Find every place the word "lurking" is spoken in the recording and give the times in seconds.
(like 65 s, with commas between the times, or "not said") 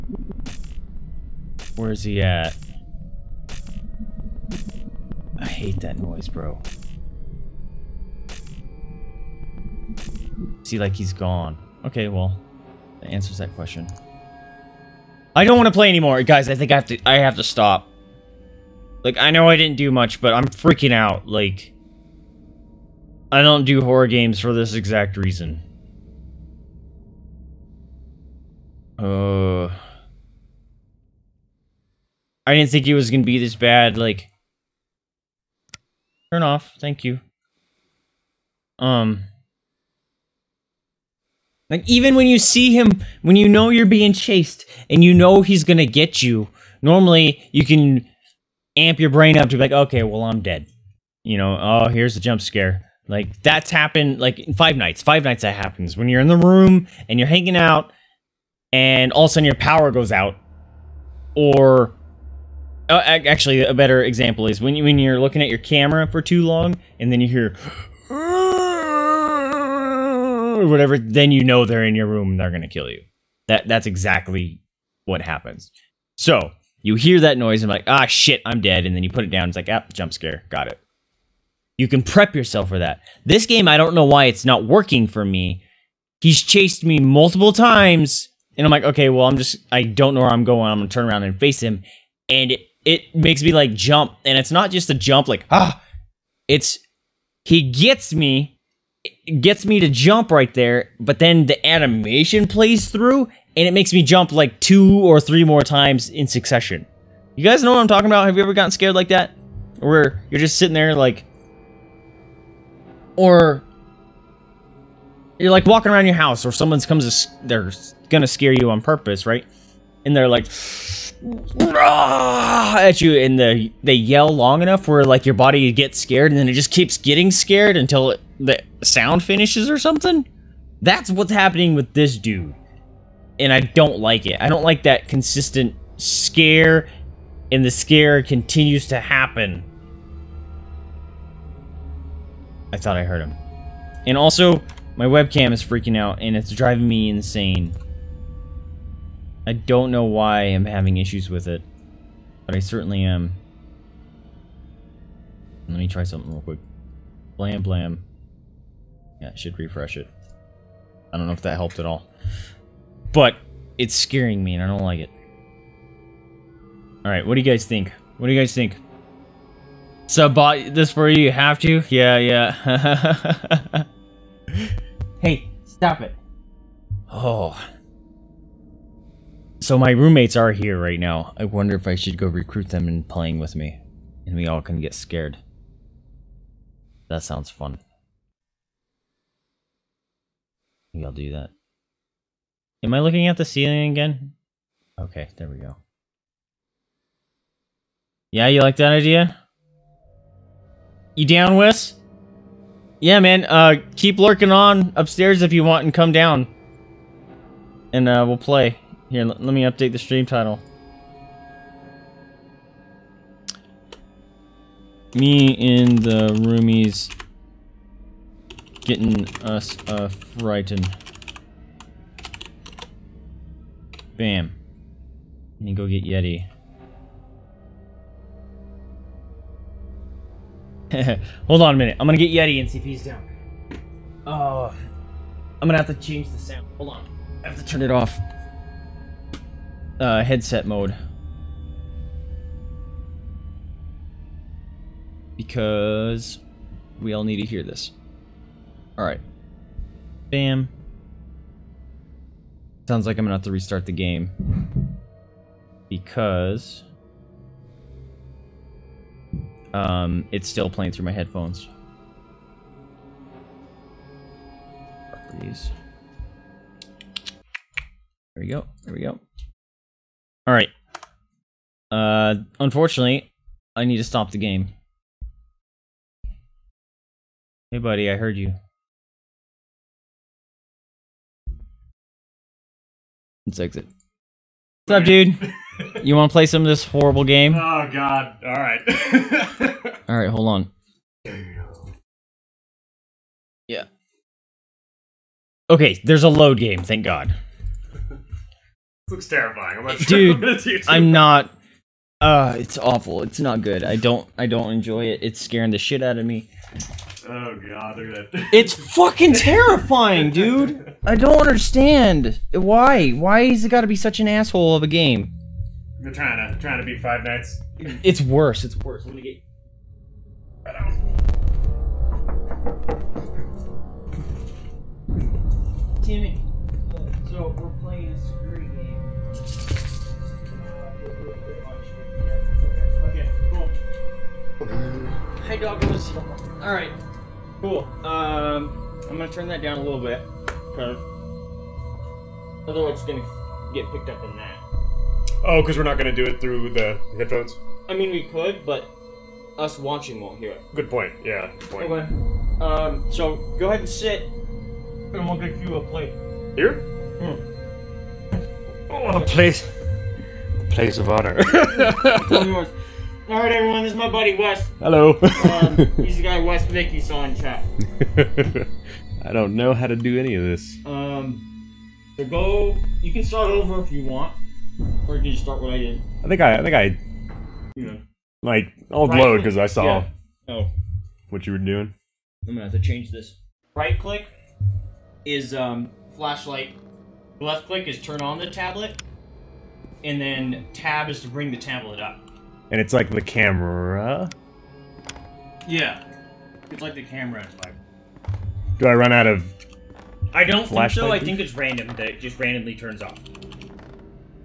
204 s.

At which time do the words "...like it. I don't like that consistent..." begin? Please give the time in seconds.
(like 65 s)
133 s.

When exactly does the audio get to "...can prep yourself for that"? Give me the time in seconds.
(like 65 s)
81 s.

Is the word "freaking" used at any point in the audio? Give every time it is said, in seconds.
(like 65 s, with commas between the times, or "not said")
20 s, 145 s.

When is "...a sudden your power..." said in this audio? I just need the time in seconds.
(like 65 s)
59 s.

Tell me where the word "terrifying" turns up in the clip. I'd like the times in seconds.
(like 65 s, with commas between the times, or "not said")
299 s, 309 s.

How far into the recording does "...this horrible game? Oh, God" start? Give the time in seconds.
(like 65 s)
286 s.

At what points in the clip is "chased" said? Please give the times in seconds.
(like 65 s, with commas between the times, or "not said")
44 s, 86 s.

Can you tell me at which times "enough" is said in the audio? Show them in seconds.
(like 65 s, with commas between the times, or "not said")
124 s.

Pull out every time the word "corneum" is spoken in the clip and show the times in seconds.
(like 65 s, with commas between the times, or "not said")
not said.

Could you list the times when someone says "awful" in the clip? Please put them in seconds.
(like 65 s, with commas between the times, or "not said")
302 s.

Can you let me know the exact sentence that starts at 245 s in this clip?
Because we all need to hear this.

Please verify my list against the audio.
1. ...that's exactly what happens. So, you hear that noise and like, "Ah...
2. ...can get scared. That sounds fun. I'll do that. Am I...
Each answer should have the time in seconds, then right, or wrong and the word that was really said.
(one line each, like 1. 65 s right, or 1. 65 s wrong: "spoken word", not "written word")
1. 73 s right
2. 184 s right.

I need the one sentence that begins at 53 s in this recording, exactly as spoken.
Like that's happened like five nights.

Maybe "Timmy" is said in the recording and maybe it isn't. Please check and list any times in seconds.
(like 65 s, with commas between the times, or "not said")
326 s.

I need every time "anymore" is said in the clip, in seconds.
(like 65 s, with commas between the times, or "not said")
15 s.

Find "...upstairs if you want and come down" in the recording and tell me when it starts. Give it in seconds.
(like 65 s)
204 s.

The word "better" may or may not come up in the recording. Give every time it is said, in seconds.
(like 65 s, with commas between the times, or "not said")
63 s.